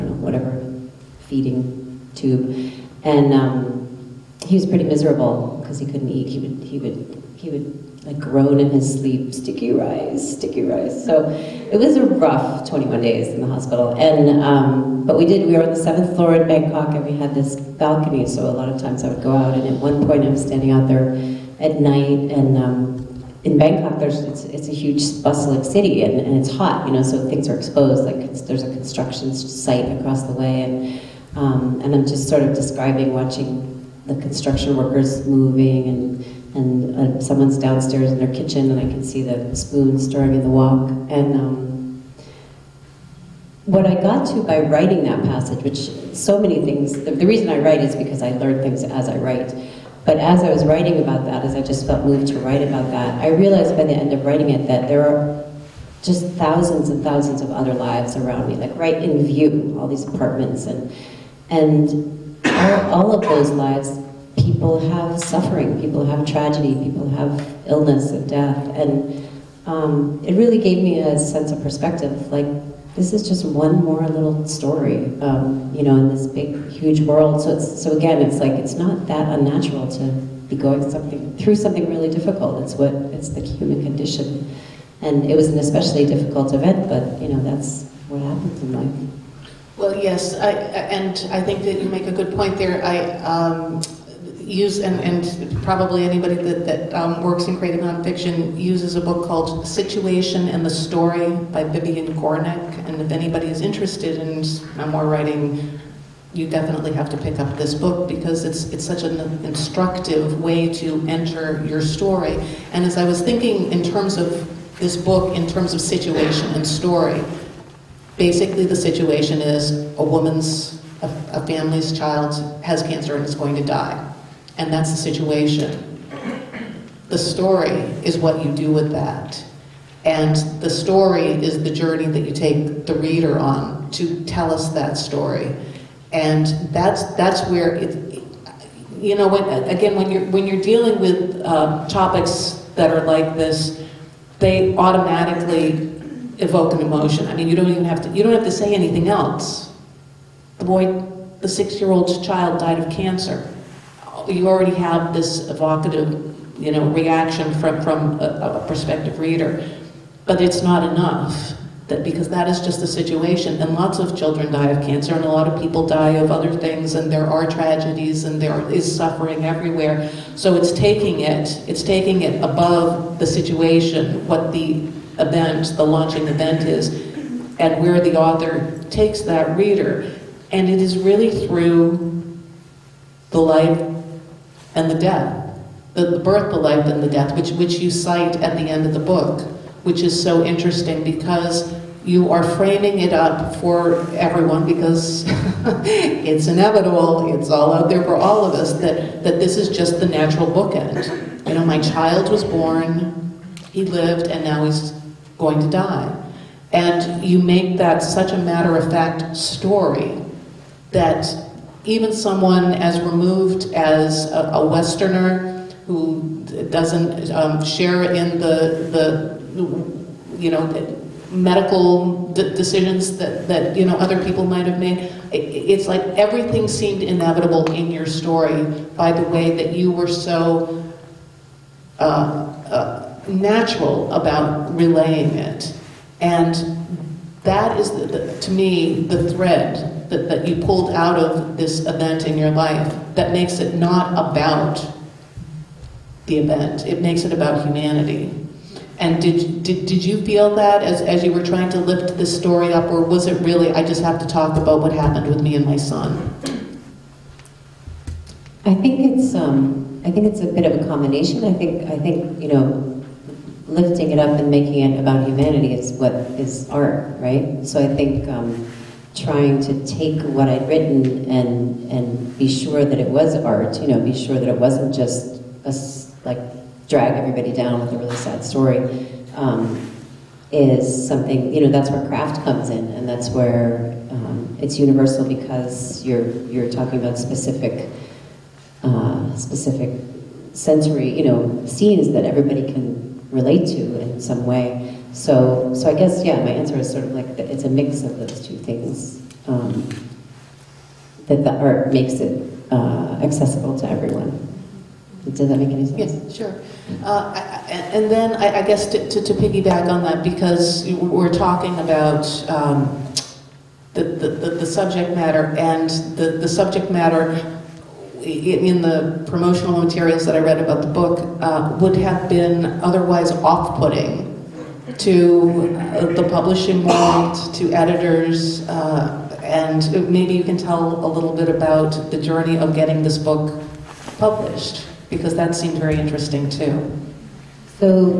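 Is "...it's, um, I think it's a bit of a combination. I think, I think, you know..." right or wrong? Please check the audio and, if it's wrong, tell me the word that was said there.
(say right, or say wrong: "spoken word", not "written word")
right.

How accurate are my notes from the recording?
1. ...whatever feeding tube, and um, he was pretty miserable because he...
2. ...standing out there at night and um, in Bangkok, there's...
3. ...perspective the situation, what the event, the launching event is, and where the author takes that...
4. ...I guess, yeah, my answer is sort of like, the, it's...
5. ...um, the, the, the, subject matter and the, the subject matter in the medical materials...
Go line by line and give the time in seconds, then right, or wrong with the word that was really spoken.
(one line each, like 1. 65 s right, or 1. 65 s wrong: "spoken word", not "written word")
1. 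0 s right
2. 20 s right
3. 172 s wrong: "above", not "perspective"
4. 295 s right
5. 312 s wrong: "promotional", not "medical".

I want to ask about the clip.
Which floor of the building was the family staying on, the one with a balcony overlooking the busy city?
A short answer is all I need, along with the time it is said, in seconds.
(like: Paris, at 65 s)
seventh floor, at 15 s.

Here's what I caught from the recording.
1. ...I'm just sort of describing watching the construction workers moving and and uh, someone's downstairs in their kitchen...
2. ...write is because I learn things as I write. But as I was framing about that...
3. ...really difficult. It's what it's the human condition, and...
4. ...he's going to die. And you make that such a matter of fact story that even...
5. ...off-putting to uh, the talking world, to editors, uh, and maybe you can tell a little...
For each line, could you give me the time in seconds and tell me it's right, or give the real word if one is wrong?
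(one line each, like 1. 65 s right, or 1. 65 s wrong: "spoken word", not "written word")
1. 31 s right
2. 47 s wrong: "writing", not "framing"
3. 81 s right
4. 204 s right
5. 323 s wrong: "publishing", not "talking".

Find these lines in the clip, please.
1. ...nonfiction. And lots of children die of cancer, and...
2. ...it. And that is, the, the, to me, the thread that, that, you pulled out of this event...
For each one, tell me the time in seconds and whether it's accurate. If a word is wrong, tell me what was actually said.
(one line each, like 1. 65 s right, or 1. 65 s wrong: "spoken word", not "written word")
1. 162 s wrong: "situation", not "nonfiction"
2. 235 s right.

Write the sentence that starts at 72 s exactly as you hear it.
Like this is just one more little story, um, you know, in this big, huge world.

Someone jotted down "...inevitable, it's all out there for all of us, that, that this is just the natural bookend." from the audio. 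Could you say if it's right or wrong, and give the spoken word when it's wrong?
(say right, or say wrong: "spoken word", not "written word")
right.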